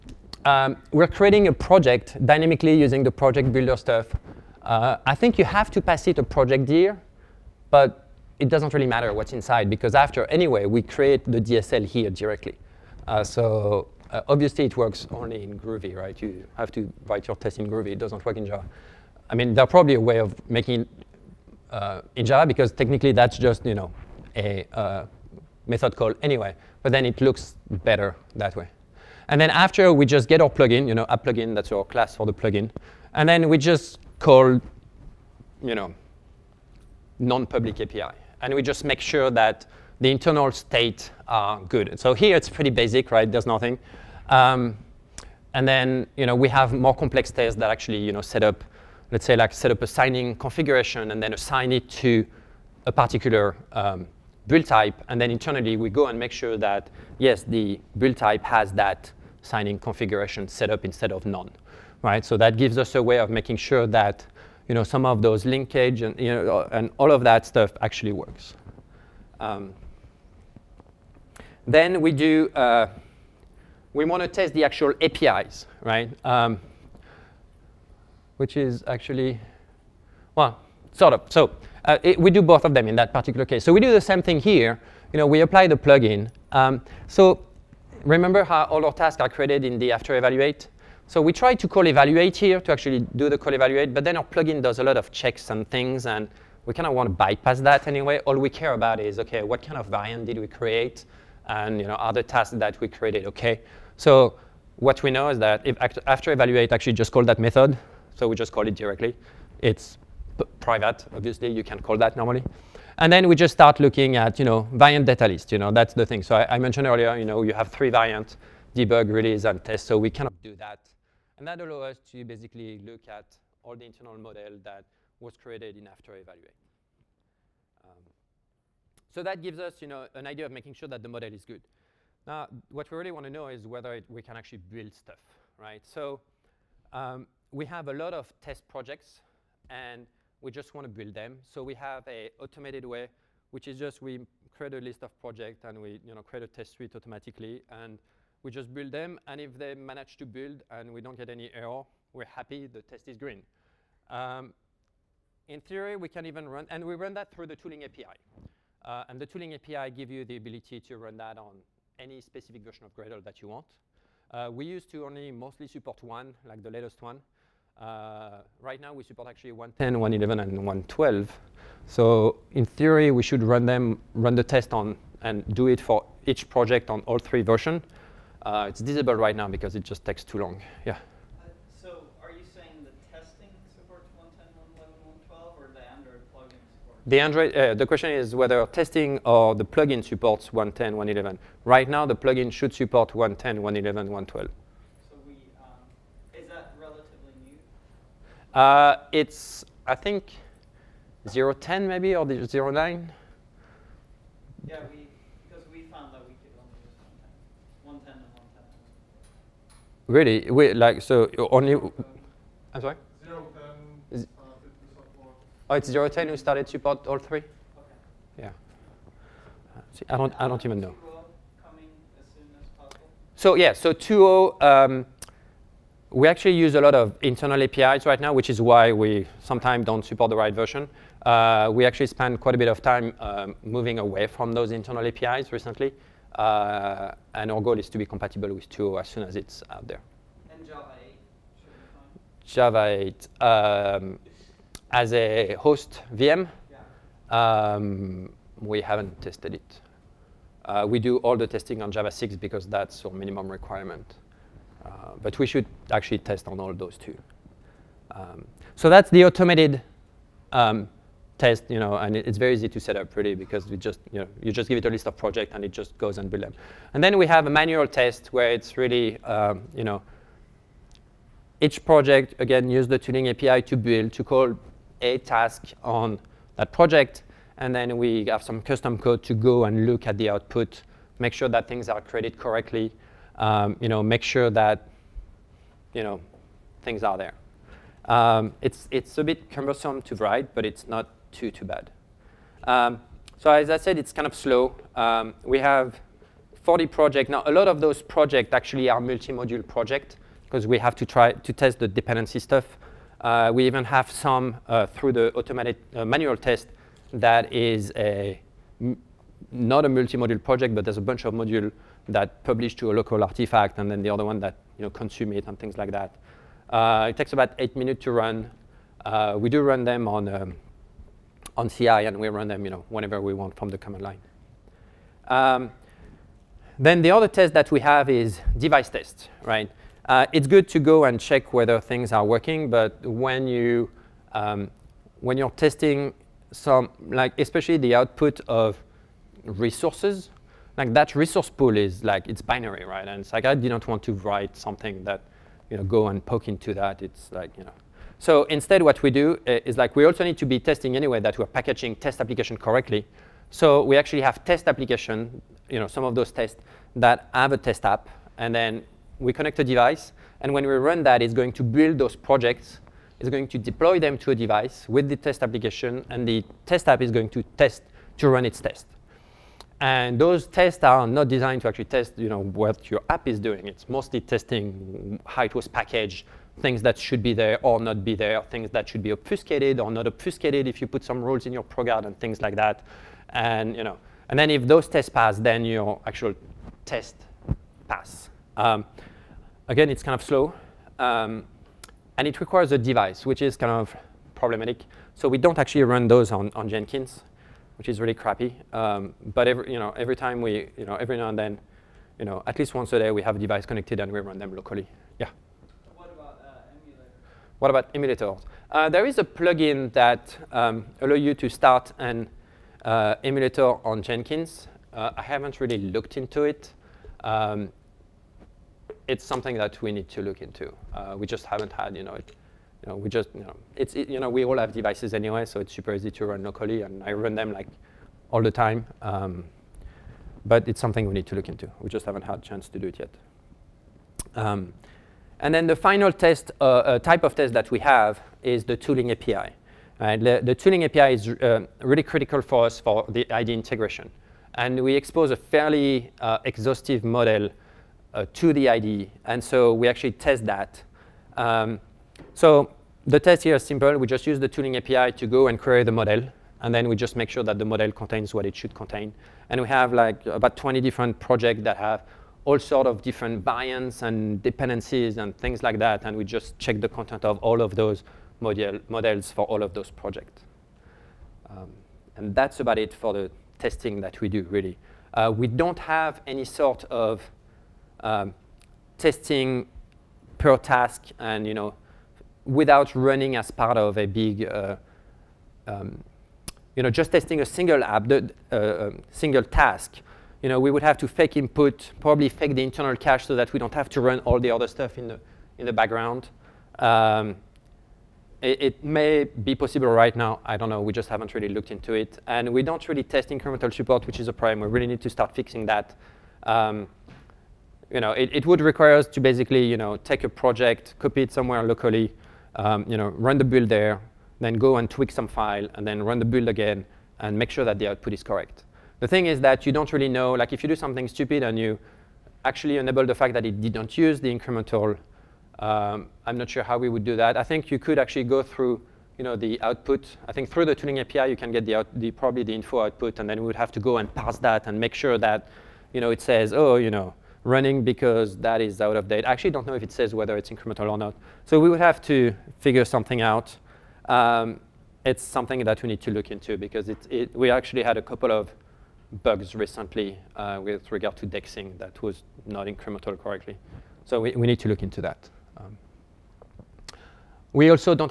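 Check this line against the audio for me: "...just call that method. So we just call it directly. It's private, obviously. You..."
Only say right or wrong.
right.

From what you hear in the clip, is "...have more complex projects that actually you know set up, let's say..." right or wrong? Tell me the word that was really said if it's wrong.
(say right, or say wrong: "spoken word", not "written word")
wrong: "tests", not "projects".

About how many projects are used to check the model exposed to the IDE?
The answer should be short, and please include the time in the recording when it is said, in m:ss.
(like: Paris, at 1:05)
20, at 7:40.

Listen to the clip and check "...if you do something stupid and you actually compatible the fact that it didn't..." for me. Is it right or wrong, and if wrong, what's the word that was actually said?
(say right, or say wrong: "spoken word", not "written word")
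wrong: "enable", not "compatible".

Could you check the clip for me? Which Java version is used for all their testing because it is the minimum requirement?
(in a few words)
Java 6.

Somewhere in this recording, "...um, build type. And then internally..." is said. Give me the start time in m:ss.
0:53.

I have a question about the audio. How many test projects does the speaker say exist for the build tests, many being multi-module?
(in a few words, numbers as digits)
40.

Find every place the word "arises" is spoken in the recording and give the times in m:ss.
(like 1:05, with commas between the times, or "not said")
not said.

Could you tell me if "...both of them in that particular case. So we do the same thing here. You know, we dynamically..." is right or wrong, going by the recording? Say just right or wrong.
wrong.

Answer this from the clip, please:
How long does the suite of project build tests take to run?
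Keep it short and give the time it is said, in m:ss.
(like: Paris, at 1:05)
8 minutes, at 5:17.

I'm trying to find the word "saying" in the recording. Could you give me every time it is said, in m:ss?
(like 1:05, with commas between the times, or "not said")
3:02.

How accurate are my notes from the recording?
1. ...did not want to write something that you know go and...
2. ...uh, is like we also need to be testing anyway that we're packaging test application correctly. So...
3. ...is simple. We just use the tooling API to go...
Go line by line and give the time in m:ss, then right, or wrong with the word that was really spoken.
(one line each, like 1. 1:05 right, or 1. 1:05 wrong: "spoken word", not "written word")
1. 5:43 right
2. 5:49 right
3. 7:33 right.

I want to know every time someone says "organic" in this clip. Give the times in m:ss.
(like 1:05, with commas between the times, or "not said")
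not said.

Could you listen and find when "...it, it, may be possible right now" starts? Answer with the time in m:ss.
8:18.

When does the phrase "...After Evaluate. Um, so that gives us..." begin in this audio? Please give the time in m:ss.
2:05.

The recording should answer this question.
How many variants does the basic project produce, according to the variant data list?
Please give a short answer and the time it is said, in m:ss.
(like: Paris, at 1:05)
3, at 1:57.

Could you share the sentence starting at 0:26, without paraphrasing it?
But then it looks better that way.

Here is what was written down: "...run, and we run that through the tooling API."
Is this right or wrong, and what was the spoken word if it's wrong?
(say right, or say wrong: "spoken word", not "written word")
right.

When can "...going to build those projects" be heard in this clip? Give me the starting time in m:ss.
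6:01.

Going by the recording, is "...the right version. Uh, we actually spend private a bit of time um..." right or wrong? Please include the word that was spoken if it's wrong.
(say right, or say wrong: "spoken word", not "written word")
wrong: "quite", not "private".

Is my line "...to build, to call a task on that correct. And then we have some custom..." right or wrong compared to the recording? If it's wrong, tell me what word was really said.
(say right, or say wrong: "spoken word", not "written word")
wrong: "project", not "correct".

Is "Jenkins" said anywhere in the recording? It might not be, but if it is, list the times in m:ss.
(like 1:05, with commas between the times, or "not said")
6:36, 6:54.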